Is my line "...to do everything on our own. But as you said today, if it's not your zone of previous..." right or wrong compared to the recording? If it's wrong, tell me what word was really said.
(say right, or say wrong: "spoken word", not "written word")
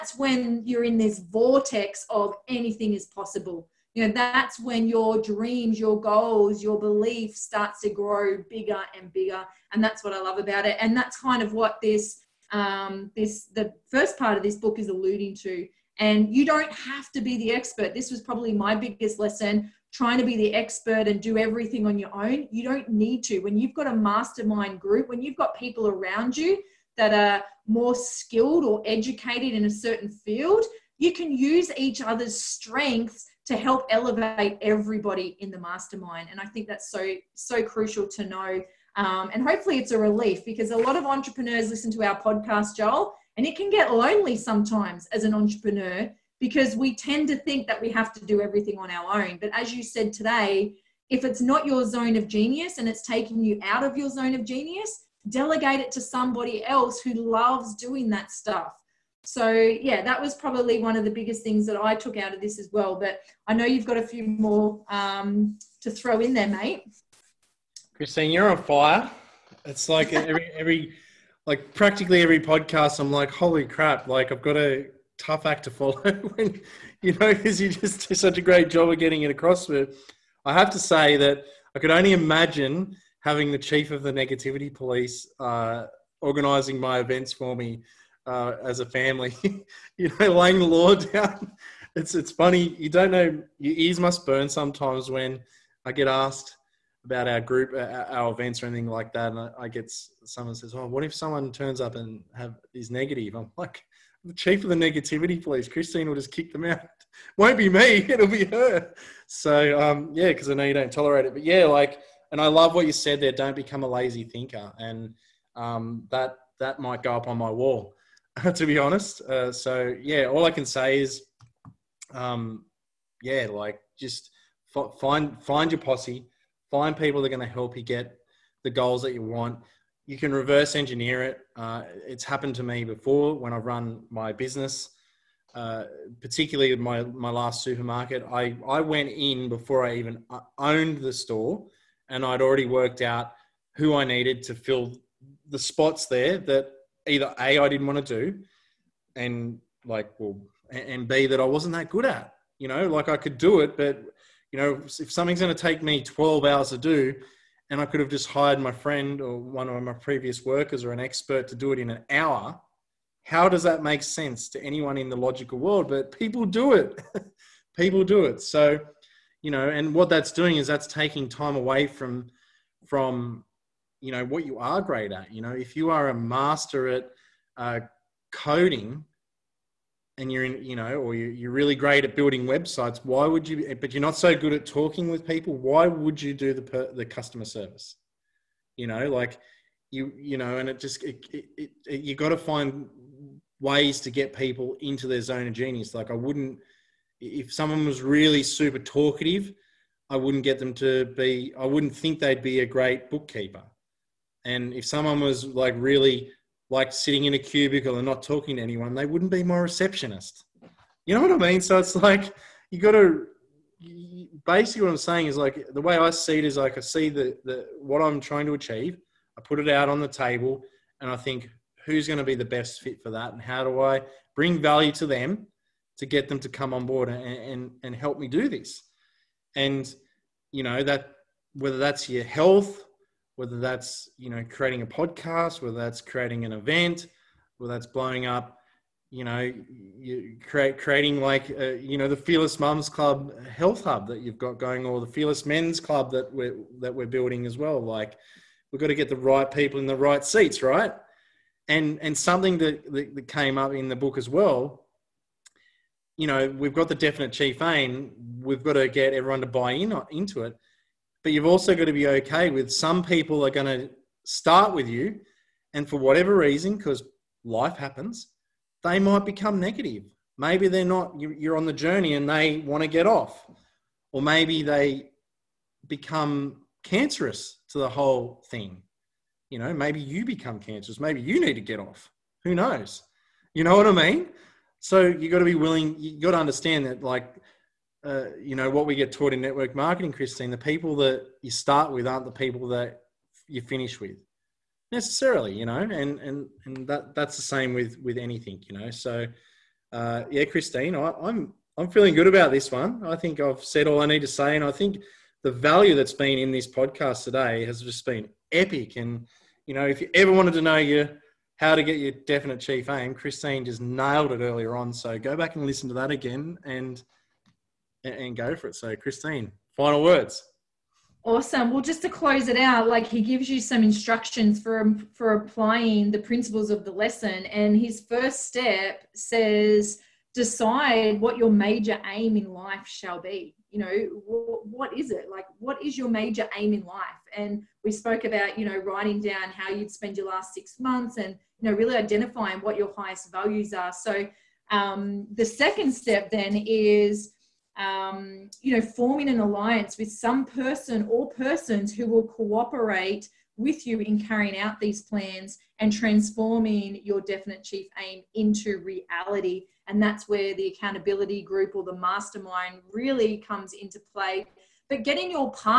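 wrong: "genius", not "previous".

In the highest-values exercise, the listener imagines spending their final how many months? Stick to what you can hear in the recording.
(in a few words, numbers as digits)
6.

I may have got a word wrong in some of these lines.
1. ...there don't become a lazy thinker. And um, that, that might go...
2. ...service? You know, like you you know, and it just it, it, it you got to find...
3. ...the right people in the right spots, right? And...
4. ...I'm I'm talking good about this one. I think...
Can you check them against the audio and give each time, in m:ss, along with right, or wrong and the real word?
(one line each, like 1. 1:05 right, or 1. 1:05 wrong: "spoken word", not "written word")
1. 1:53 right
2. 3:07 right
3. 4:09 wrong: "seats", not "spots"
4. 5:01 wrong: "feeling", not "talking".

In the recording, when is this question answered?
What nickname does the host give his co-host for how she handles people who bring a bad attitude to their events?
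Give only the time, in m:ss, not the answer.
1:23.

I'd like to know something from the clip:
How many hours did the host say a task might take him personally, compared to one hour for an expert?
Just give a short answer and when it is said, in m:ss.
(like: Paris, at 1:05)
12, at 2:36.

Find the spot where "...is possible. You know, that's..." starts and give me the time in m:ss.
0:02.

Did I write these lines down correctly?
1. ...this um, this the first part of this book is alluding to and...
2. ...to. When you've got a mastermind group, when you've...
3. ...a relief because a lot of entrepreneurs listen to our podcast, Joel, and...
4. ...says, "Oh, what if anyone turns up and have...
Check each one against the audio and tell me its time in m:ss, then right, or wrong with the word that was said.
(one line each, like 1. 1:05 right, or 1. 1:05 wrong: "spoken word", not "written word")
1. 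0:11 right
2. 0:23 right
3. 0:39 right
4. 1:40 wrong: "someone", not "anyone".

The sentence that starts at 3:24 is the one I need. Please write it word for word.
And if someone was like really like sitting in a cubicle and not talking to anyone, they wouldn't be my receptionist.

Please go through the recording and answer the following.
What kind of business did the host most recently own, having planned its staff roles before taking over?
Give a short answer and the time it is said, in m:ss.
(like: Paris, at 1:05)
Supermarket, at 2:17.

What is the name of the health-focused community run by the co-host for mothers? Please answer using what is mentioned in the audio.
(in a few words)
Fearless Mums Club Health Hub.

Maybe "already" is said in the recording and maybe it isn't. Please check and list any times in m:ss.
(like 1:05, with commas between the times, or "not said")
2:22.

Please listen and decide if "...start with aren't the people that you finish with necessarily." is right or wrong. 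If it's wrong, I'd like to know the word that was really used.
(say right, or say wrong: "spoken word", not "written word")
right.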